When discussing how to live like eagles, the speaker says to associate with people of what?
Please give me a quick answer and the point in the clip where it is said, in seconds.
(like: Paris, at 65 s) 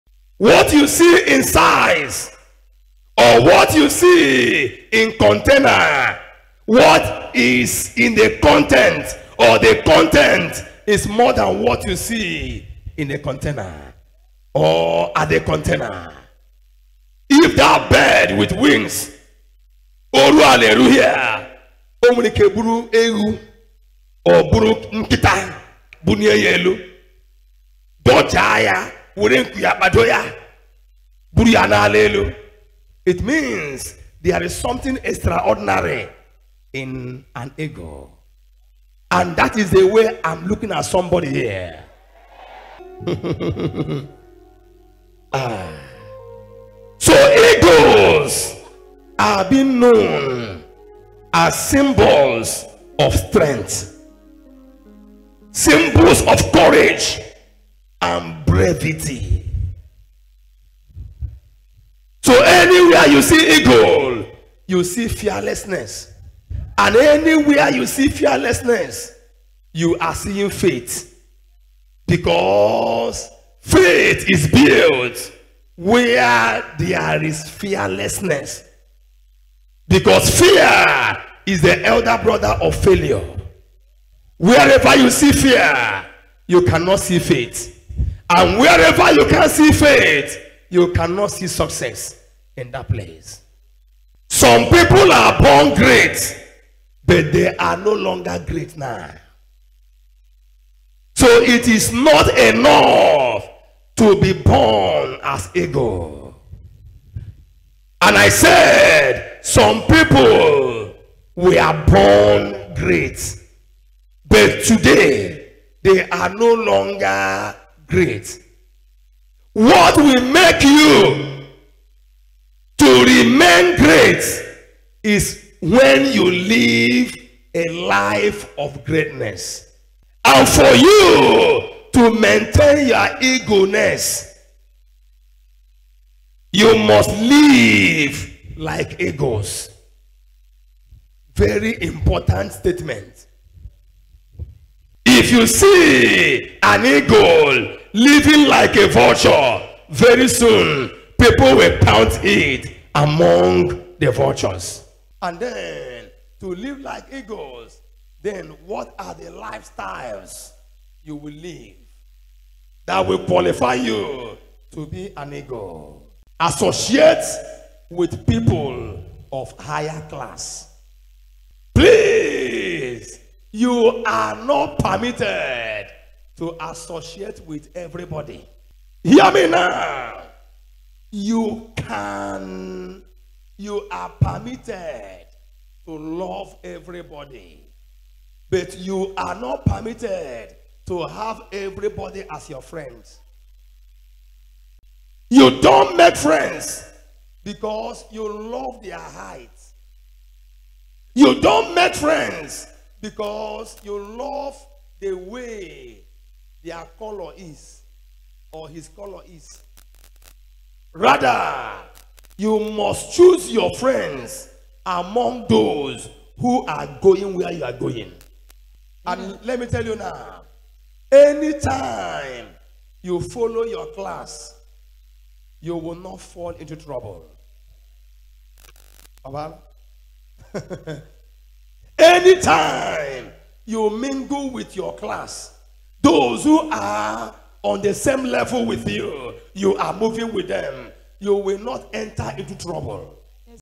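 higher class, at 169 s.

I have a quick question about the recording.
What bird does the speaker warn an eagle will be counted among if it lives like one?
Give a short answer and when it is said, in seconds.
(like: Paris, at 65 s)
vultures, at 154 s.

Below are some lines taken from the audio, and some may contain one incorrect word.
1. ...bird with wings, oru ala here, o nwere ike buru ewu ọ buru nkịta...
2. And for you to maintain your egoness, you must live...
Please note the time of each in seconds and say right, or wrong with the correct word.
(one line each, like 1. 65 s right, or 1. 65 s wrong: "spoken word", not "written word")
1. 17 s right
2. 130 s right.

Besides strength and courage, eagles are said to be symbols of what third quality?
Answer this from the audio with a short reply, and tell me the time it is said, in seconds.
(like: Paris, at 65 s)
brevity, at 58 s.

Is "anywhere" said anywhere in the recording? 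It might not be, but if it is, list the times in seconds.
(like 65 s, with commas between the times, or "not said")
62 s, 66 s.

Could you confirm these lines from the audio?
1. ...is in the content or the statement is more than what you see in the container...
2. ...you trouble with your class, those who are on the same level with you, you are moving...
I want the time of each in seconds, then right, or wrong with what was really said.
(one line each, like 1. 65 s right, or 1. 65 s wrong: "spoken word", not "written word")
1. 7 s wrong: "content", not "statement"
2. 233 s wrong: "mingle", not "trouble".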